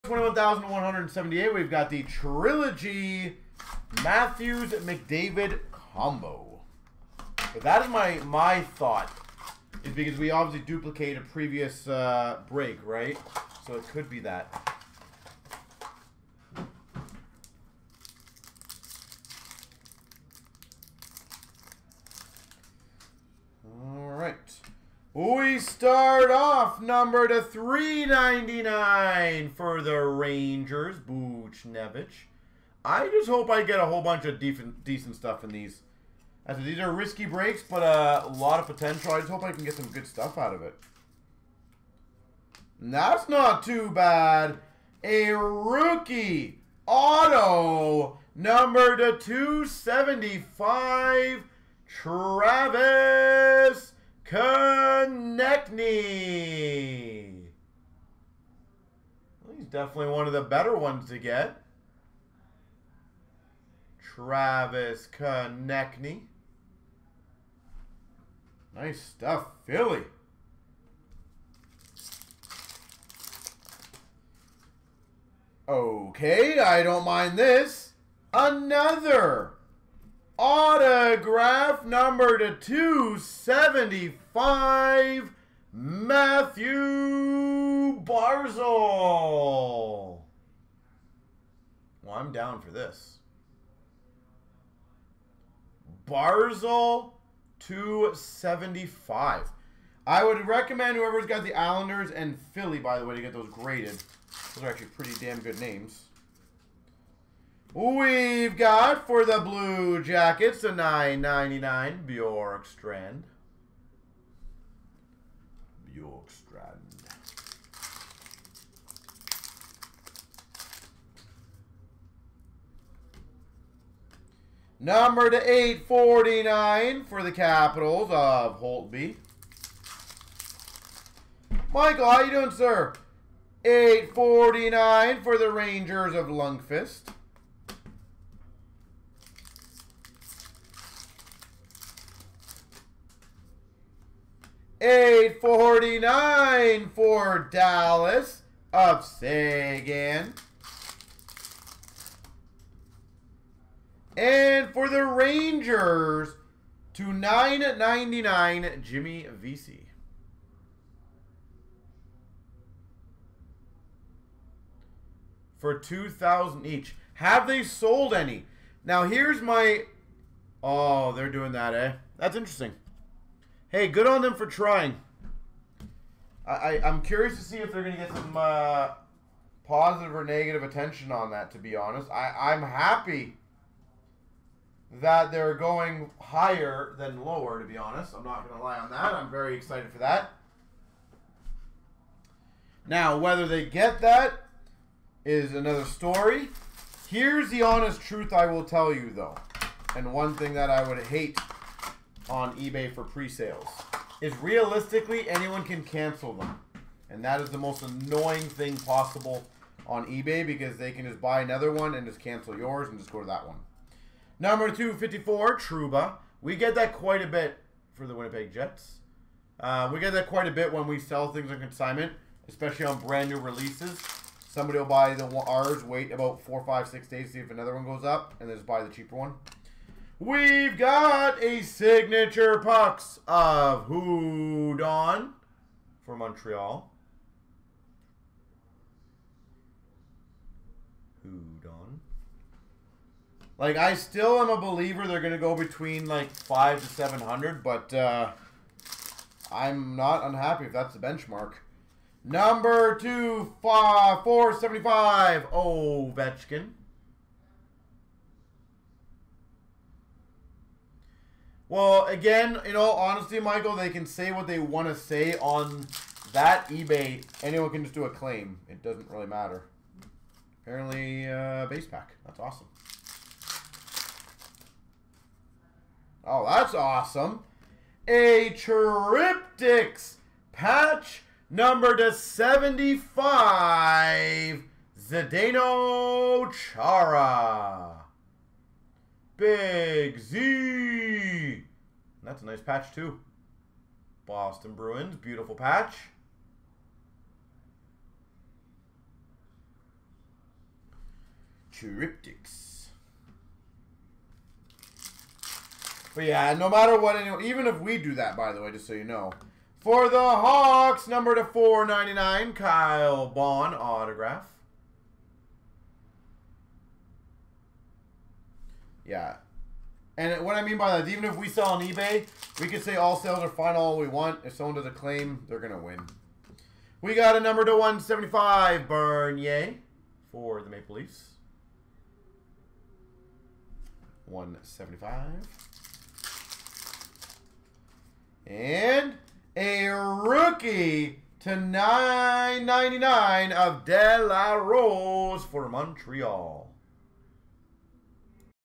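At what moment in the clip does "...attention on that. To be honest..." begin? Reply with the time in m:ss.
3:00.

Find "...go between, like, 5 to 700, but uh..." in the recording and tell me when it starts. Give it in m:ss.
4:05.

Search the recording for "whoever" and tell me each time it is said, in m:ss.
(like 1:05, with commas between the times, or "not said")
1:40.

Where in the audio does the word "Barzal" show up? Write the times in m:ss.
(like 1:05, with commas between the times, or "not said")
1:28, 1:36.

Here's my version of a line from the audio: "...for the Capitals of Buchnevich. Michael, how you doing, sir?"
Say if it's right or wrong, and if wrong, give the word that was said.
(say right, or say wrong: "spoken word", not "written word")
wrong: "Holtby", not "Buchnevich".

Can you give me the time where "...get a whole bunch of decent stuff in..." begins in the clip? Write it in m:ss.
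0:33.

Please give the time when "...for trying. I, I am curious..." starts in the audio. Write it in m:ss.
2:54.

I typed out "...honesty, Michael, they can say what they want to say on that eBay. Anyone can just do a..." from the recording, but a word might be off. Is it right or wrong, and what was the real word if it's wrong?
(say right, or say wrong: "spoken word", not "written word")
right.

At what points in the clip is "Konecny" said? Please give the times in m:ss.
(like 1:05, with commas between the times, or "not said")
0:55, 1:05.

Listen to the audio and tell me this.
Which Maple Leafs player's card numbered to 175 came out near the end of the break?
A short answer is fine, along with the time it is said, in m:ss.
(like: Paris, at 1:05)
Bernier, at 5:28.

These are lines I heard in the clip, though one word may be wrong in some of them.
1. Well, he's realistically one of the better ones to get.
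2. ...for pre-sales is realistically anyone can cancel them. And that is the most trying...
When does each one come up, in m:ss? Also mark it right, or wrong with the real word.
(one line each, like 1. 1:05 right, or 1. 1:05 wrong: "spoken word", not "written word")
1. 0:59 wrong: "definitely", not "realistically"
2. 3:22 wrong: "annoying", not "trying".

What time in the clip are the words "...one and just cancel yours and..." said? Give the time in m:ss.
3:31.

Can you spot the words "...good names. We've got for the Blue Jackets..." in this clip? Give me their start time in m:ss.
1:45.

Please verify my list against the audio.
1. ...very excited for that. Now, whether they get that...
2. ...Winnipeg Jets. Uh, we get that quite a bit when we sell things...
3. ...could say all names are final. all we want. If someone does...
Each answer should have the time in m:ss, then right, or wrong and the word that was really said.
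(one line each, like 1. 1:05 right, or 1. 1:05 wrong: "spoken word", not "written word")
1. 3:09 right
2. 3:38 right
3. 5:22 wrong: "sales", not "names".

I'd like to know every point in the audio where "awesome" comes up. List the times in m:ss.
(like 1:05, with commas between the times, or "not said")
4:32, 4:36.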